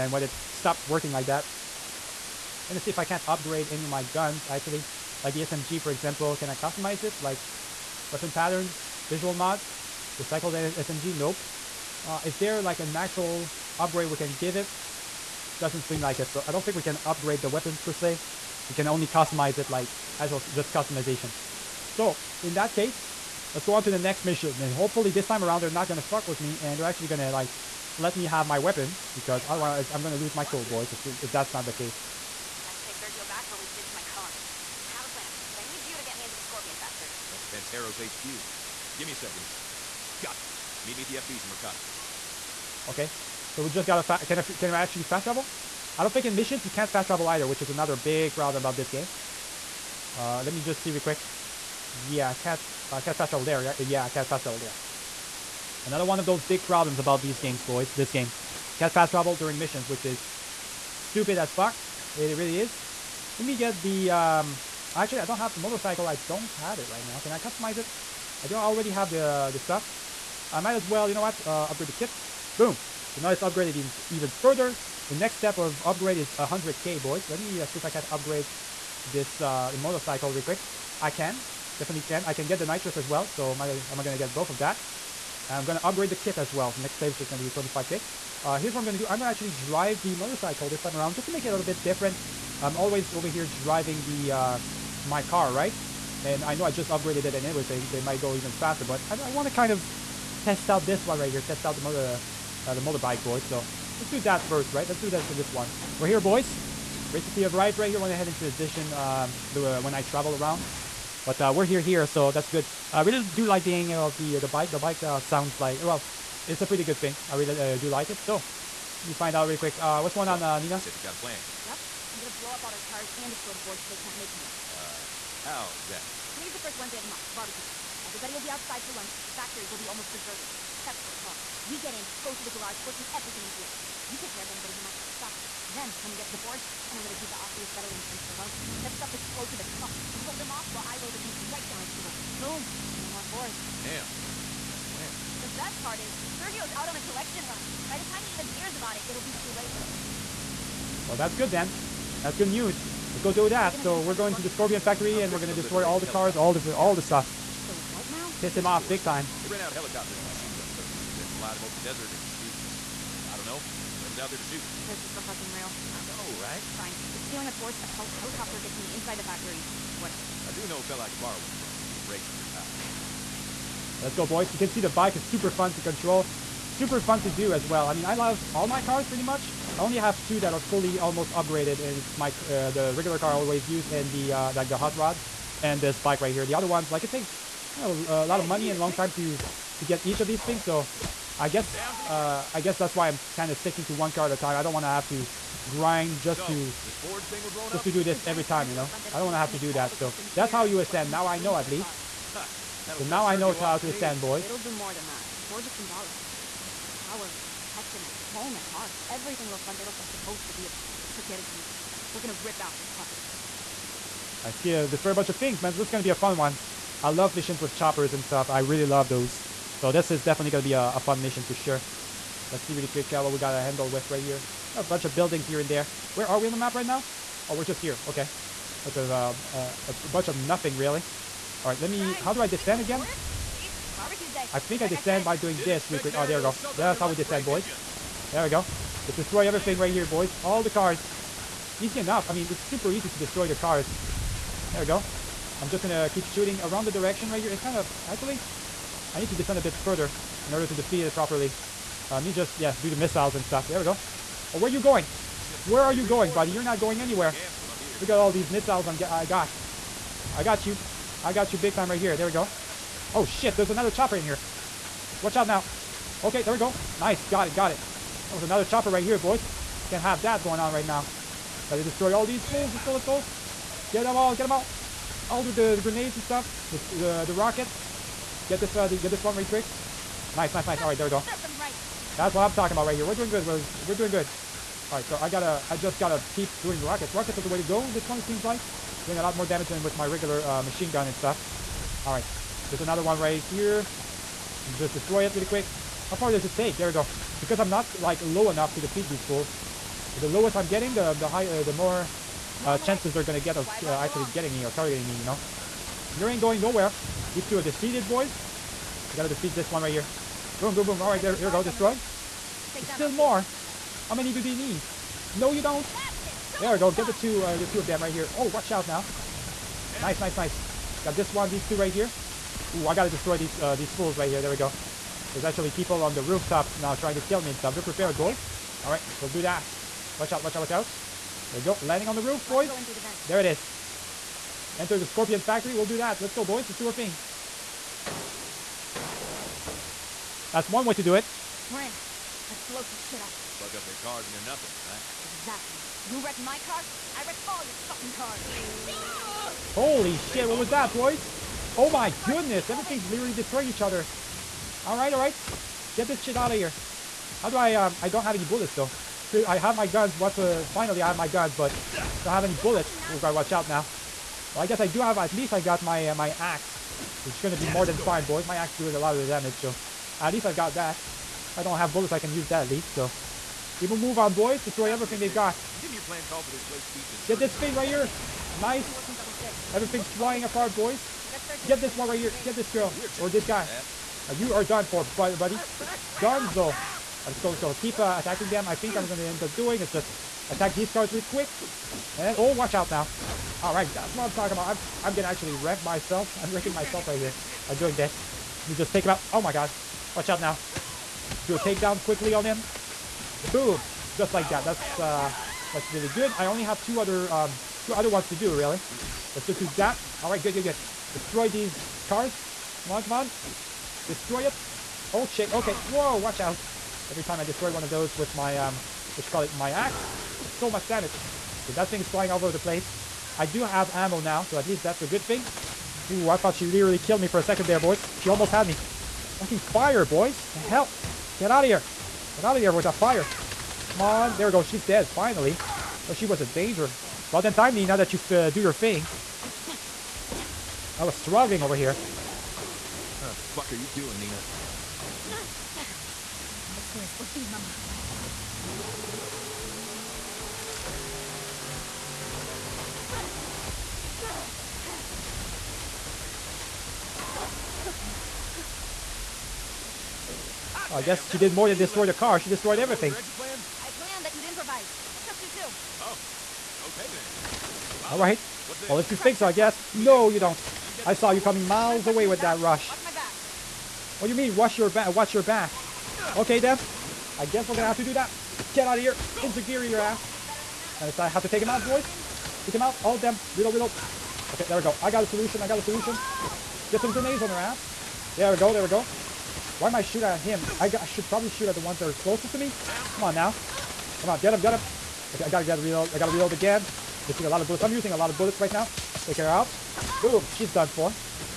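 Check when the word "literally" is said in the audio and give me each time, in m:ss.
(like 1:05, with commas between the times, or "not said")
5:53, 7:06.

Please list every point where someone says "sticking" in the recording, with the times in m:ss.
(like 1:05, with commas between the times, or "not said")
3:13.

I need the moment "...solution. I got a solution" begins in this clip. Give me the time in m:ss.
8:05.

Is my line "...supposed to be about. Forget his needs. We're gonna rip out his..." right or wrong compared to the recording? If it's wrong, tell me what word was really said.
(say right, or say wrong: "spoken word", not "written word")
right.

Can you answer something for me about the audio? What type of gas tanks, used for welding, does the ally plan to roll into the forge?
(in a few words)
oxyacetylene.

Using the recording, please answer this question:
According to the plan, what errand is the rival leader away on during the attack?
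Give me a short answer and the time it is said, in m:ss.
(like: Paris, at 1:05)
a collection run, at 2:26.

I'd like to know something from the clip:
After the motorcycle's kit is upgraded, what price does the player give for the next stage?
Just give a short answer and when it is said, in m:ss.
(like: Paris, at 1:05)
25k, at 1:27.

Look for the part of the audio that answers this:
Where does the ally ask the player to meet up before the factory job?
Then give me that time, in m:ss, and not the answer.
0:41.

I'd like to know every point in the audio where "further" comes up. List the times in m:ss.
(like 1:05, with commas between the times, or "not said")
1:14, 4:09.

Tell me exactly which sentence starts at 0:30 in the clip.
If, if that's not the case.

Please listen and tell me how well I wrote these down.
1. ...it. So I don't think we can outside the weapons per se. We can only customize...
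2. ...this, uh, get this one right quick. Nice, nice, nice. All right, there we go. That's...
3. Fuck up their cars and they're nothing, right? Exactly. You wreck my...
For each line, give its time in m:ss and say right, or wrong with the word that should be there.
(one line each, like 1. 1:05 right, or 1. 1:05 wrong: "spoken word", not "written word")
1. 0:16 wrong: "upgrade", not "outside"
2. 4:38 right
3. 5:43 right.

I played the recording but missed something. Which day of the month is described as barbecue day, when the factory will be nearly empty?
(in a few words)
first Wednesday.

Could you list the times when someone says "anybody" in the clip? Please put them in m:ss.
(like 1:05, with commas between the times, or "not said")
2:14.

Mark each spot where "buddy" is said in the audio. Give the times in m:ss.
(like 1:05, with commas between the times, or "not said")
4:16, 6:25.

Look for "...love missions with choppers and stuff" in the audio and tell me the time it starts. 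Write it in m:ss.
3:37.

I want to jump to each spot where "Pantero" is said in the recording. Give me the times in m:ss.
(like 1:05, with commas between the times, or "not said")
0:37, 3:29.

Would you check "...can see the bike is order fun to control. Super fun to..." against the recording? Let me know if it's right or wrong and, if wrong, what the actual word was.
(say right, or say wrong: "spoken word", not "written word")
wrong: "super", not "order".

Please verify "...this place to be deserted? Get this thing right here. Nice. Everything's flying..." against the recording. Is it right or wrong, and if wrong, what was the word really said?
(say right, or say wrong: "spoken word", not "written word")
right.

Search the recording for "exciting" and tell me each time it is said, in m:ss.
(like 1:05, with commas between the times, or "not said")
not said.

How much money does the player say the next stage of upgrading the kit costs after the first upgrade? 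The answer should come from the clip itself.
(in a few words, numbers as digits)
100k.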